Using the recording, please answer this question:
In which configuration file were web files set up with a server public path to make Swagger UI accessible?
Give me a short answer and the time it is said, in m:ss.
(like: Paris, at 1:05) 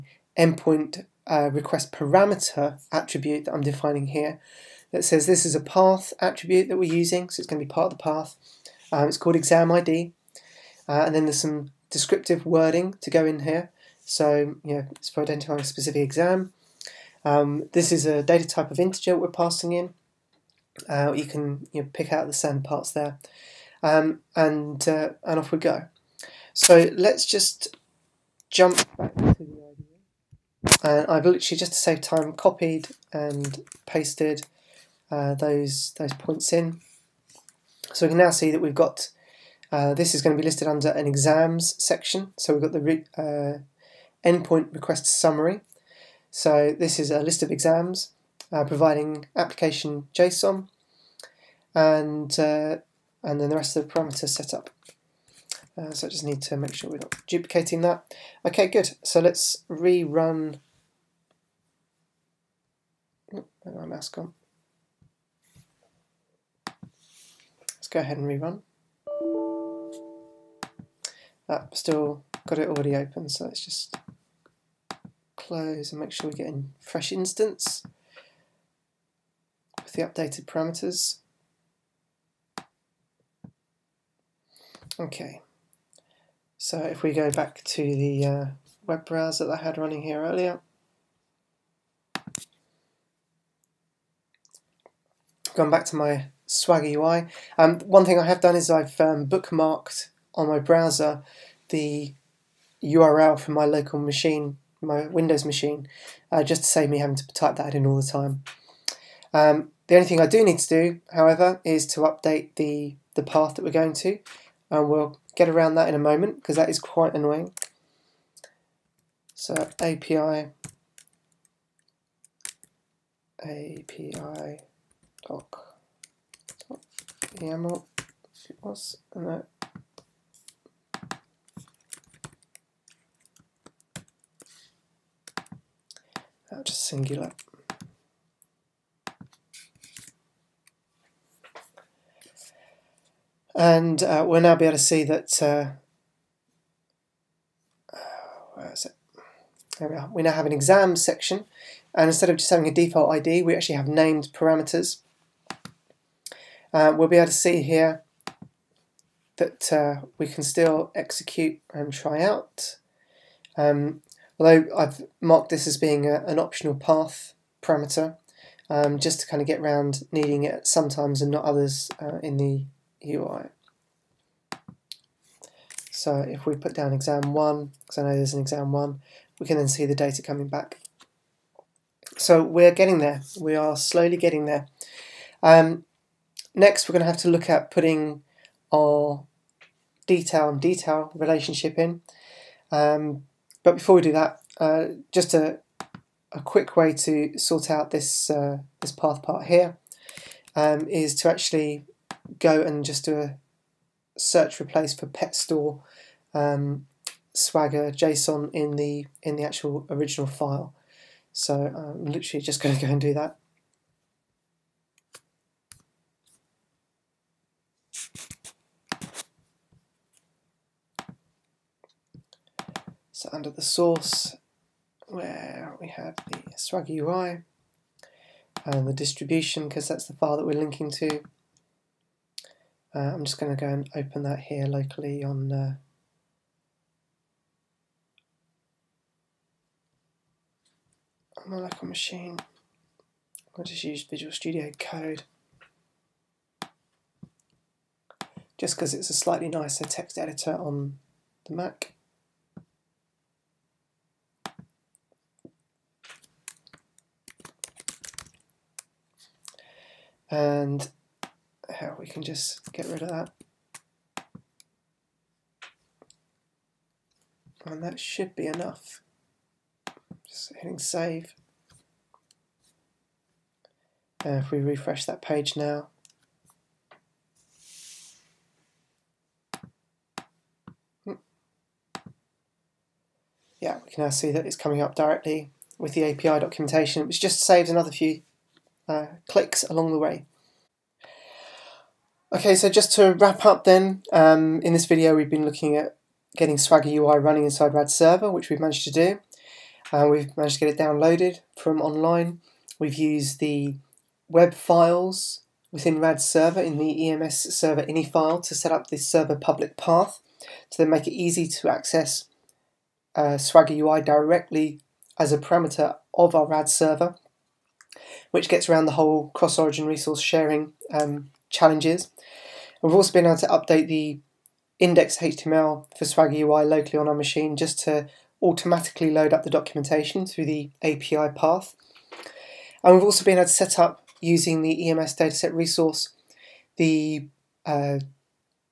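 EMS server ini file, at 5:07.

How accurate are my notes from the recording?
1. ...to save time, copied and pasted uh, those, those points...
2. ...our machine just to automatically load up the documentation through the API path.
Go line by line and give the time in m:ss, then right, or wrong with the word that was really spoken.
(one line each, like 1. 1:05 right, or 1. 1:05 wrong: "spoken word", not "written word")
1. 0:31 right
2. 5:27 right.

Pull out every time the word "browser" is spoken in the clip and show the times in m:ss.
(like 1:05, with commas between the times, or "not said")
1:29, 1:40.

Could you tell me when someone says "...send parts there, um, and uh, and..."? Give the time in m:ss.
0:22.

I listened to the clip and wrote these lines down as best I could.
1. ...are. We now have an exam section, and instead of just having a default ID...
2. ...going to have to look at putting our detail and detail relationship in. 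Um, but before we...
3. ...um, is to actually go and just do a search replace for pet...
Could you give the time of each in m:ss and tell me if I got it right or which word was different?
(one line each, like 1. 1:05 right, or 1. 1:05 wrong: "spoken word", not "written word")
1. 2:29 right
2. 3:06 right
3. 3:20 right.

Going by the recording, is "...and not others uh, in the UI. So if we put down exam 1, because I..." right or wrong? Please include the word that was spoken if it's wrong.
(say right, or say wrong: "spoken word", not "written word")
right.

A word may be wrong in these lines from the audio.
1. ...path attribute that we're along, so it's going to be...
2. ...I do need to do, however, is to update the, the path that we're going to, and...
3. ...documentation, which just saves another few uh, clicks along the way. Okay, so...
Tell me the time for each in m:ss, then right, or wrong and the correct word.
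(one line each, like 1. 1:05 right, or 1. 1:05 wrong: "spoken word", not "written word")
1. 0:05 wrong: "using", not "along"
2. 1:50 right
3. 4:46 right.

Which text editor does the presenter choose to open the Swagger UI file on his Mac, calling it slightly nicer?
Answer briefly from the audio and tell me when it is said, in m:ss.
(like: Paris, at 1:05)
Visual Studio Code, at 4:04.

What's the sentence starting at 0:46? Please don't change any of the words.
So this is a list of exams uh, providing application JSON and, uh, and then the rest of the parameters set up.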